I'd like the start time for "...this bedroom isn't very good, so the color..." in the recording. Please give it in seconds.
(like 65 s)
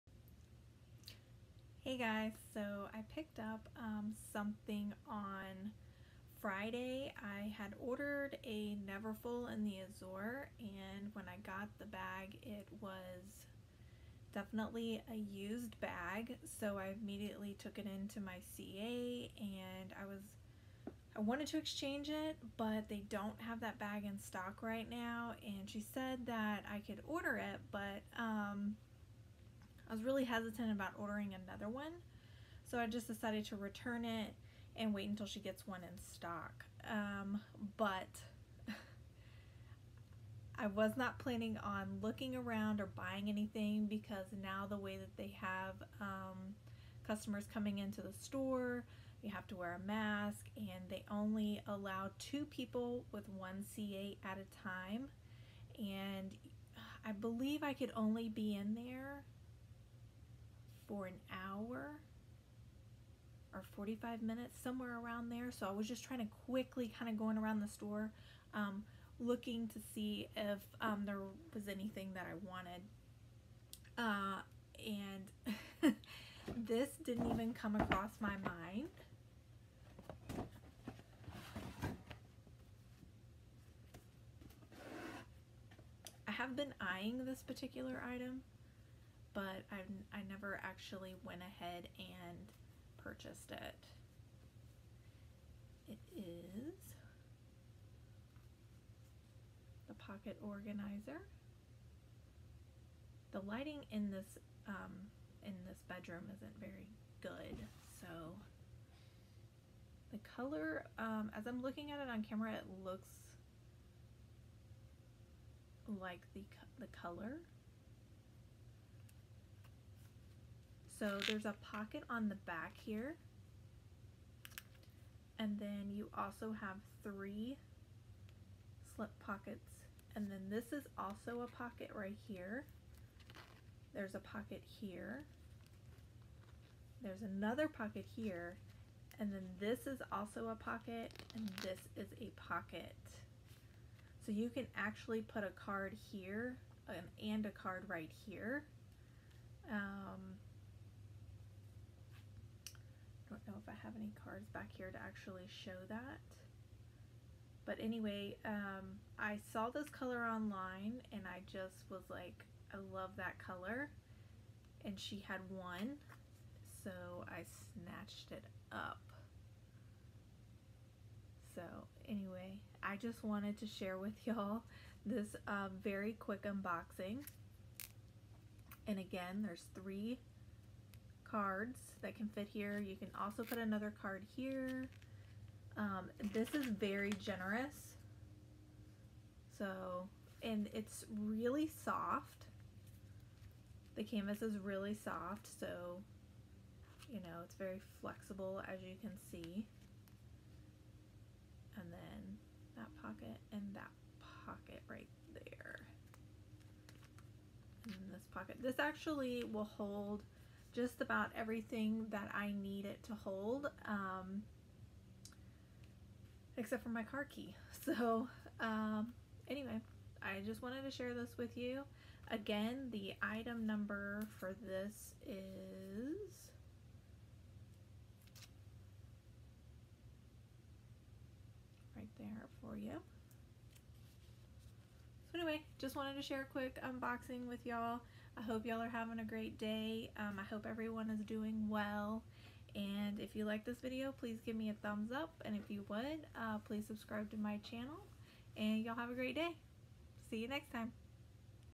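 105 s.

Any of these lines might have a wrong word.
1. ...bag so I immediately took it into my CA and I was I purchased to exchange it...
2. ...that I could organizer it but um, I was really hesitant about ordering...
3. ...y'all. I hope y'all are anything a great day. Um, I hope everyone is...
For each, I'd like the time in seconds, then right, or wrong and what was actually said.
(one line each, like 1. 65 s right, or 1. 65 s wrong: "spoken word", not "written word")
1. 15 s wrong: "wanted", not "purchased"
2. 26 s wrong: "order", not "organizer"
3. 237 s wrong: "having", not "anything".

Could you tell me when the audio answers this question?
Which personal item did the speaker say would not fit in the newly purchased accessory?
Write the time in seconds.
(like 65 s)
217 s.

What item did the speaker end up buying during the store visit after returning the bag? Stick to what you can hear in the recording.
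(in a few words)
pocket organizer.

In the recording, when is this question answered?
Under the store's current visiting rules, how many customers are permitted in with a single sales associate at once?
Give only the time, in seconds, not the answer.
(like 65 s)
52 s.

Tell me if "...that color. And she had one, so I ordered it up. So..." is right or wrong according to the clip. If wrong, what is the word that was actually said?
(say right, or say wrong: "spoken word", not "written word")
wrong: "snatched", not "ordered".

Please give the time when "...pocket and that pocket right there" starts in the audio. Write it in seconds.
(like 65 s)
203 s.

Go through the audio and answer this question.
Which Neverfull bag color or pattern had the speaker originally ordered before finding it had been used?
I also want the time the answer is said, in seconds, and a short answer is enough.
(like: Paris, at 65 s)
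Azur, at 9 s.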